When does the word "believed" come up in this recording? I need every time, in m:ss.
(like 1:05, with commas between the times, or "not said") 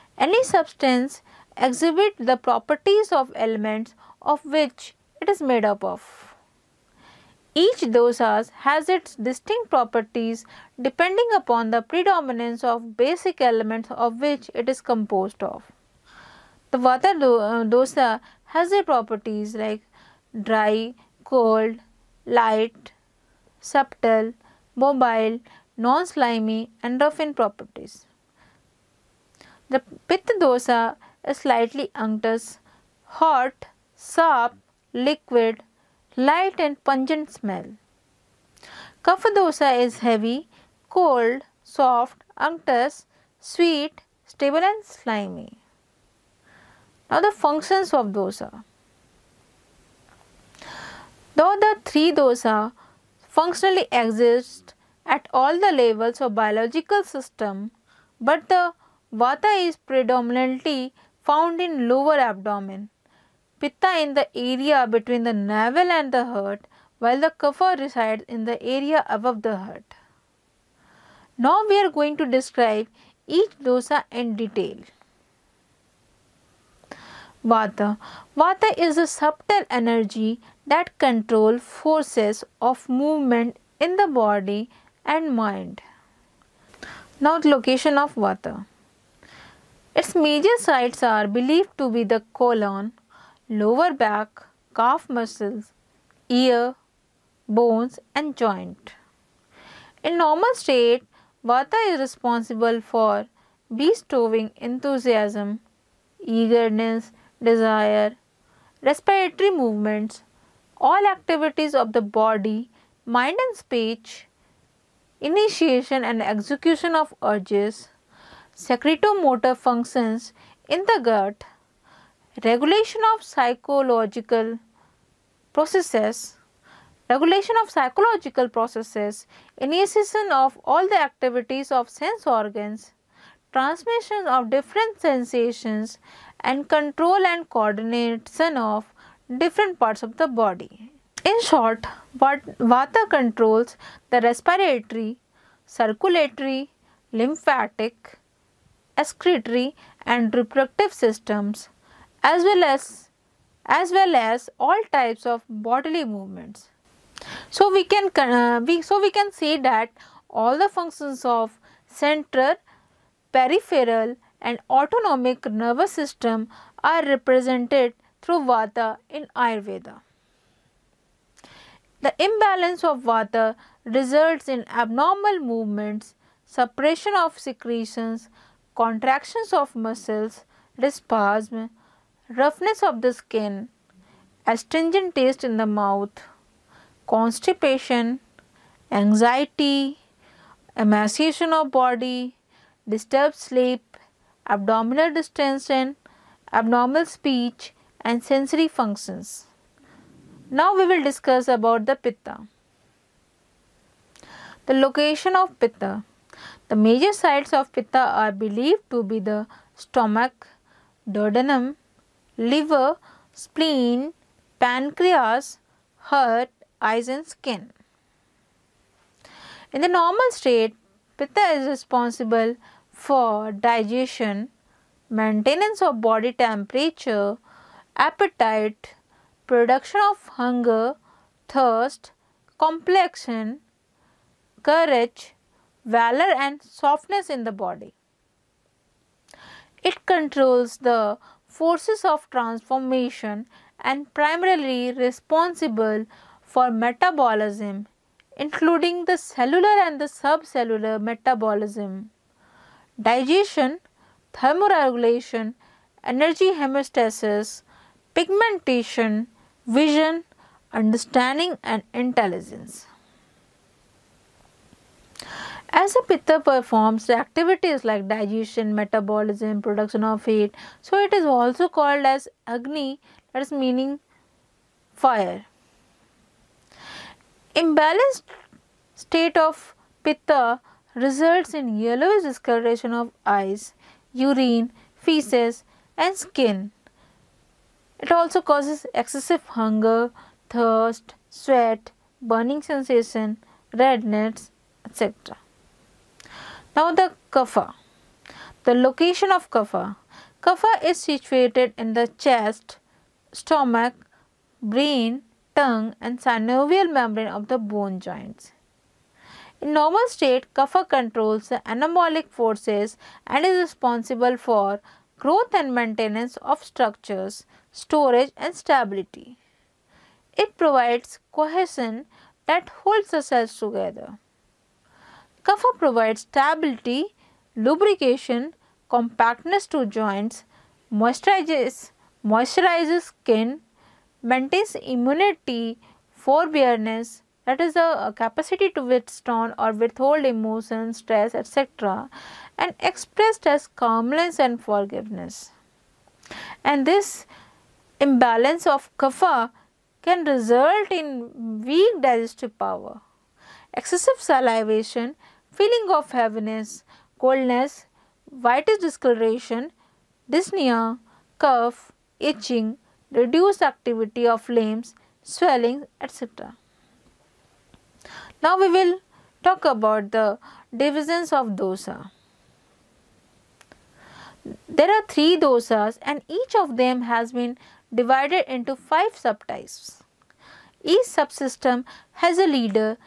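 1:31, 3:28.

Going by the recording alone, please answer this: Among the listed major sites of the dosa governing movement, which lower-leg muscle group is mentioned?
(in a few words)
Calf muscles.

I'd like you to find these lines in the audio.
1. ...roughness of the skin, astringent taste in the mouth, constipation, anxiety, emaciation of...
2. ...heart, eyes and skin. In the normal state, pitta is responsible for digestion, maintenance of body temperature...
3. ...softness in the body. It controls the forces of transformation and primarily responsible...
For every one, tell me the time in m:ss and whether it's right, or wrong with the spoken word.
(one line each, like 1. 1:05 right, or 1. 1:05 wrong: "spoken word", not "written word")
1. 3:02 right
2. 3:36 right
3. 3:56 right.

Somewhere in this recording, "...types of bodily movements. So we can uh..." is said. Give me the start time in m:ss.
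2:34.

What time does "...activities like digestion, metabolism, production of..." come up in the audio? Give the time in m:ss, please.
4:27.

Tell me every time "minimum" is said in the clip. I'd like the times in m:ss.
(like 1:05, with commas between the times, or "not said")
not said.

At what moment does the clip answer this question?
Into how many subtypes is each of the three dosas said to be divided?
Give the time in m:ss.
6:18.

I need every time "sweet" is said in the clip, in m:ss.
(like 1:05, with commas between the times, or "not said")
0:43.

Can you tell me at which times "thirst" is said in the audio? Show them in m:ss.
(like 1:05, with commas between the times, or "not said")
3:51, 4:50.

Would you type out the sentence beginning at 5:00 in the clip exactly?
Kapha is situated in the chest, stomach, brain, tongue and synovial membrane of the bone joints.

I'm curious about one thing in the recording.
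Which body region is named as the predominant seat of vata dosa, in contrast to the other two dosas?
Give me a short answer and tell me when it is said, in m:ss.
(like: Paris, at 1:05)
Lower abdomen, at 1:01.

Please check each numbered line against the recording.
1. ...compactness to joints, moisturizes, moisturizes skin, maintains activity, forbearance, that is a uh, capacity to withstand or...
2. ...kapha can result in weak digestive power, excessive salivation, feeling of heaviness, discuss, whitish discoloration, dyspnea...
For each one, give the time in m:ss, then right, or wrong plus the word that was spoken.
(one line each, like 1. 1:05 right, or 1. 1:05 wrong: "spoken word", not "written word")
1. 5:28 wrong: "immunity", not "activity"
2. 5:48 wrong: "coldness", not "discuss".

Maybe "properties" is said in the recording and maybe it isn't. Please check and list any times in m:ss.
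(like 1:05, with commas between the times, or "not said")
0:02, 0:09, 0:18, 0:27.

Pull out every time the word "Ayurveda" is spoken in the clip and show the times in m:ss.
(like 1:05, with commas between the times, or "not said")
2:49.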